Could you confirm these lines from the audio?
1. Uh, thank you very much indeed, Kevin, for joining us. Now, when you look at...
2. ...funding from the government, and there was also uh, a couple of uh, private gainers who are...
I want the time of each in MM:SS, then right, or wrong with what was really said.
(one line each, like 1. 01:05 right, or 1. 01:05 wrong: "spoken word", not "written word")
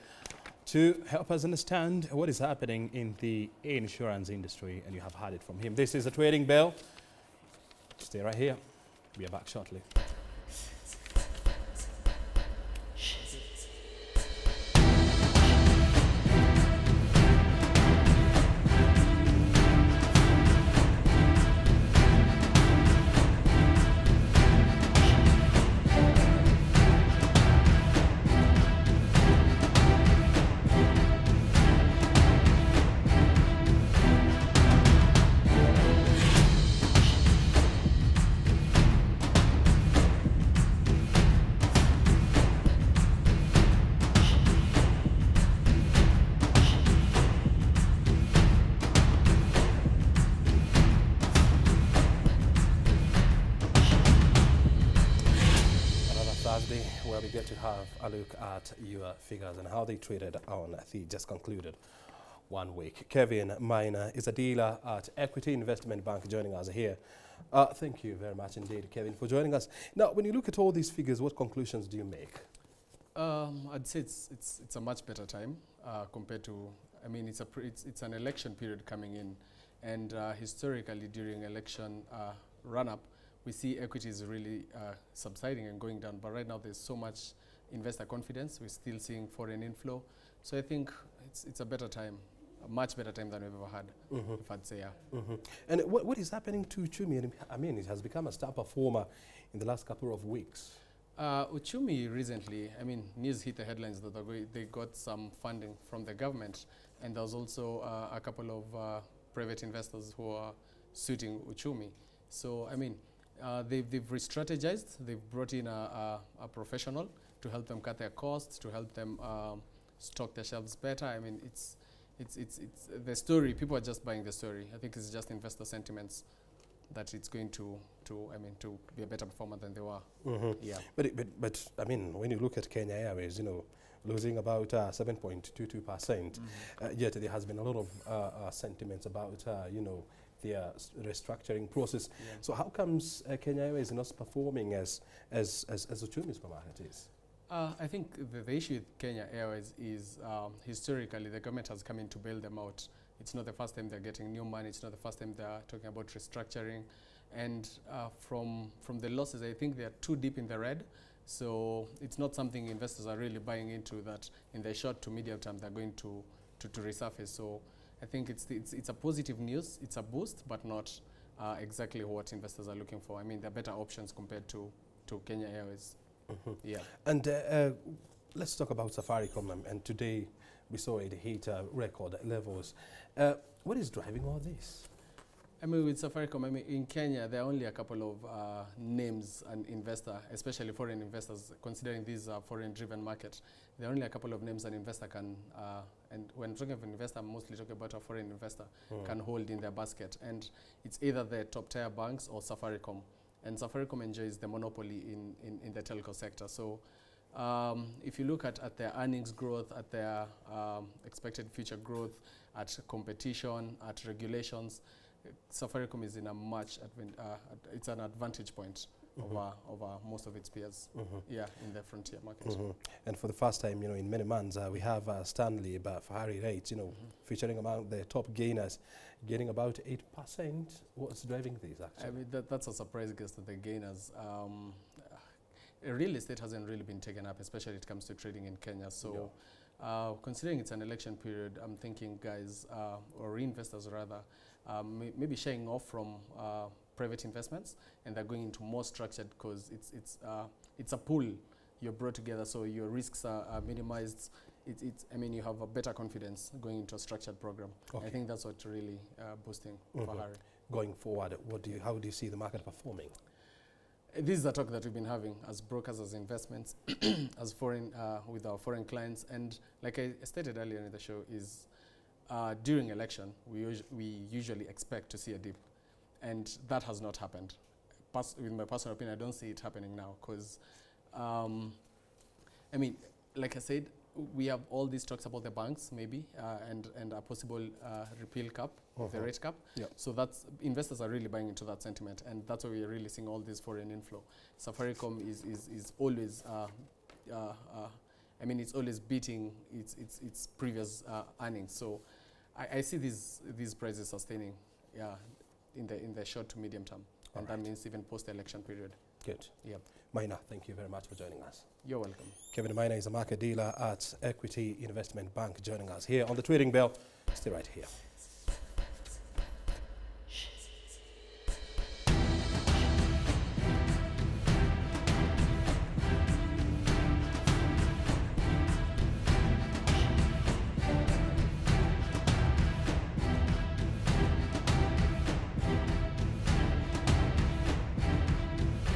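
1. 01:07 right
2. 01:45 wrong: "investors", not "gainers".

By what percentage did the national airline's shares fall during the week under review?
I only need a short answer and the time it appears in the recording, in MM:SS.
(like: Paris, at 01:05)
7.22%, at 02:14.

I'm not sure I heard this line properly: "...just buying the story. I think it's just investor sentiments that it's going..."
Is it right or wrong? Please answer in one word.
right.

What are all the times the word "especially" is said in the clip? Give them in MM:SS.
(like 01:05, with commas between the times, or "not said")
03:10, 03:57.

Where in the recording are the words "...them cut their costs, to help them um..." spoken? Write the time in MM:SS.
01:57.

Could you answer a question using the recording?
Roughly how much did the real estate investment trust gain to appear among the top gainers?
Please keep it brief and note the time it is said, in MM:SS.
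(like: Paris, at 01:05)
8%, at 03:49.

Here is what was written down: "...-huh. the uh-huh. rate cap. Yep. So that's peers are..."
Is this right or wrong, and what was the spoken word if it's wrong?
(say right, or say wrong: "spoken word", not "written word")
wrong: "investors", not "peers".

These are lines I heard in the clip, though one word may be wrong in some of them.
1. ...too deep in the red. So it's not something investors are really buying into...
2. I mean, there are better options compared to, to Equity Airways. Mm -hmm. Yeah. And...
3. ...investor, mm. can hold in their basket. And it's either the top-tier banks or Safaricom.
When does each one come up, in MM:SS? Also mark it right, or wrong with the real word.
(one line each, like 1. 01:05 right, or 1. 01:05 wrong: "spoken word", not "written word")
1. 02:40 right
2. 02:53 wrong: "Kenya", not "Equity"
3. 03:18 right.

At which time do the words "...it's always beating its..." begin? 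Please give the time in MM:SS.
04:58.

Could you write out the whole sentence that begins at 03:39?
over, over most of its peers, mm -hmm.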